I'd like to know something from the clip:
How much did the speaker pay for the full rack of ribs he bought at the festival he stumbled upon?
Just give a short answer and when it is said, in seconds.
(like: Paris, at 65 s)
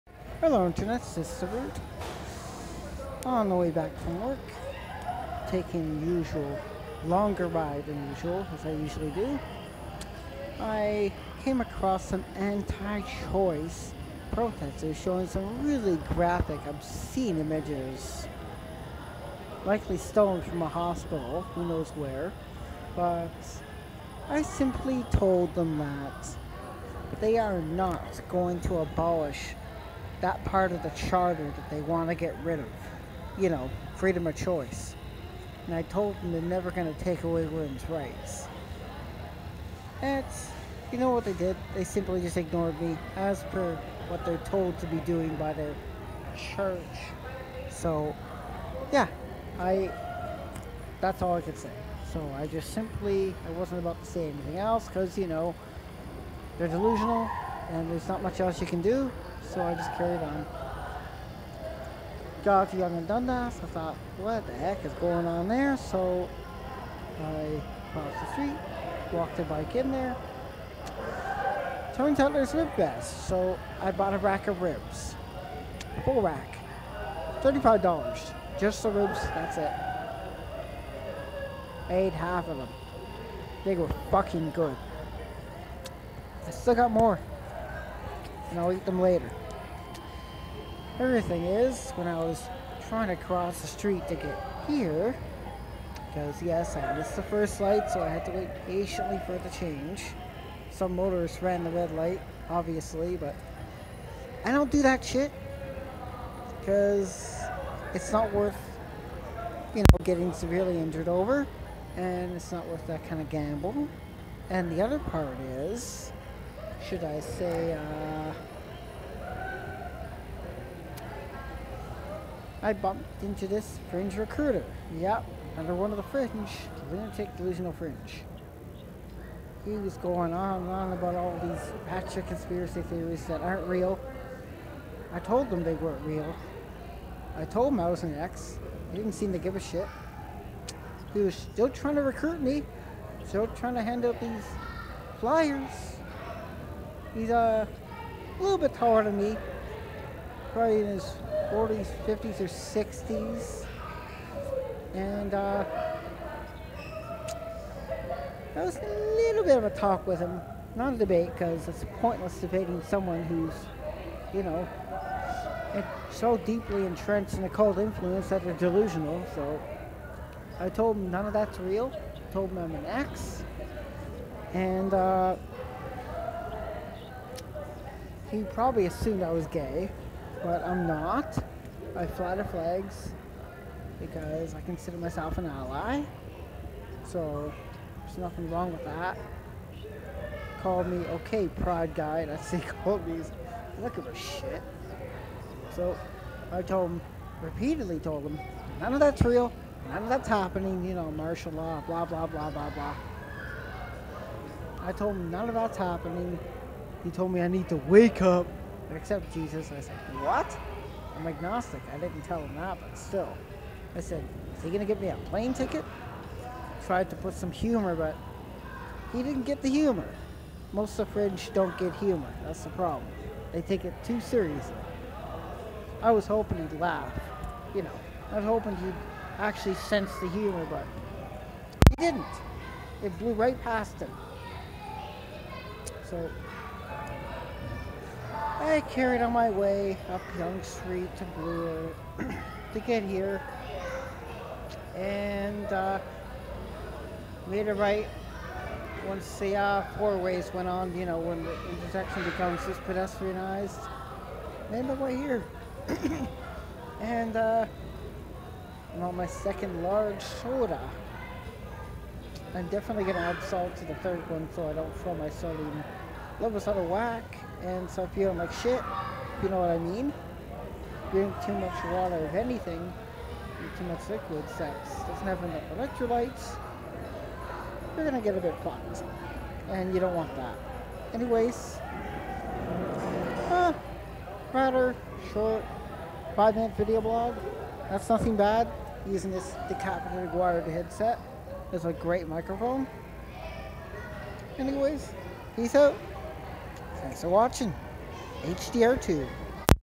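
$35, at 77 s.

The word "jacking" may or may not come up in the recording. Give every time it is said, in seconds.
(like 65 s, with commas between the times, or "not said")
not said.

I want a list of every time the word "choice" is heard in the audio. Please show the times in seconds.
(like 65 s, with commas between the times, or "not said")
12 s, 34 s.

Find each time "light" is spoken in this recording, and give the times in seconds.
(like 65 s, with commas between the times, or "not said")
97 s, 101 s.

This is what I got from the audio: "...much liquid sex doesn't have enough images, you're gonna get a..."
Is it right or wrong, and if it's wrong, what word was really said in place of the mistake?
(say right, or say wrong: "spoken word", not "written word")
wrong: "electrolytes", not "images".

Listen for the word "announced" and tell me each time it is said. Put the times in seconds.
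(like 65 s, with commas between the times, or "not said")
not said.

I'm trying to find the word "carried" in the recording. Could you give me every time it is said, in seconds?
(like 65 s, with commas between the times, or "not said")
59 s, 238 s.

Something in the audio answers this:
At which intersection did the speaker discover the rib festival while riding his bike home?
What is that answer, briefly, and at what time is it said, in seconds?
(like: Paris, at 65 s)
Yonge and Dundas, at 62 s.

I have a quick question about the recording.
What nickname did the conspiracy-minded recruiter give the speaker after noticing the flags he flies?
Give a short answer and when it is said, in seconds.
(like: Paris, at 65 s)
pride guy, at 191 s.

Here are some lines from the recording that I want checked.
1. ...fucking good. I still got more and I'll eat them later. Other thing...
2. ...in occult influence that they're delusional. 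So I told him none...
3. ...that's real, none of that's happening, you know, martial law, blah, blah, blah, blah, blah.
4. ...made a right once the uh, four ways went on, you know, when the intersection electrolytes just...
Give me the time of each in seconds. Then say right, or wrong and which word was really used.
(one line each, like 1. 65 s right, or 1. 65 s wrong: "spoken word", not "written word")
1. 84 s right
2. 167 s right
3. 199 s right
4. 247 s wrong: "becomes", not "electrolytes".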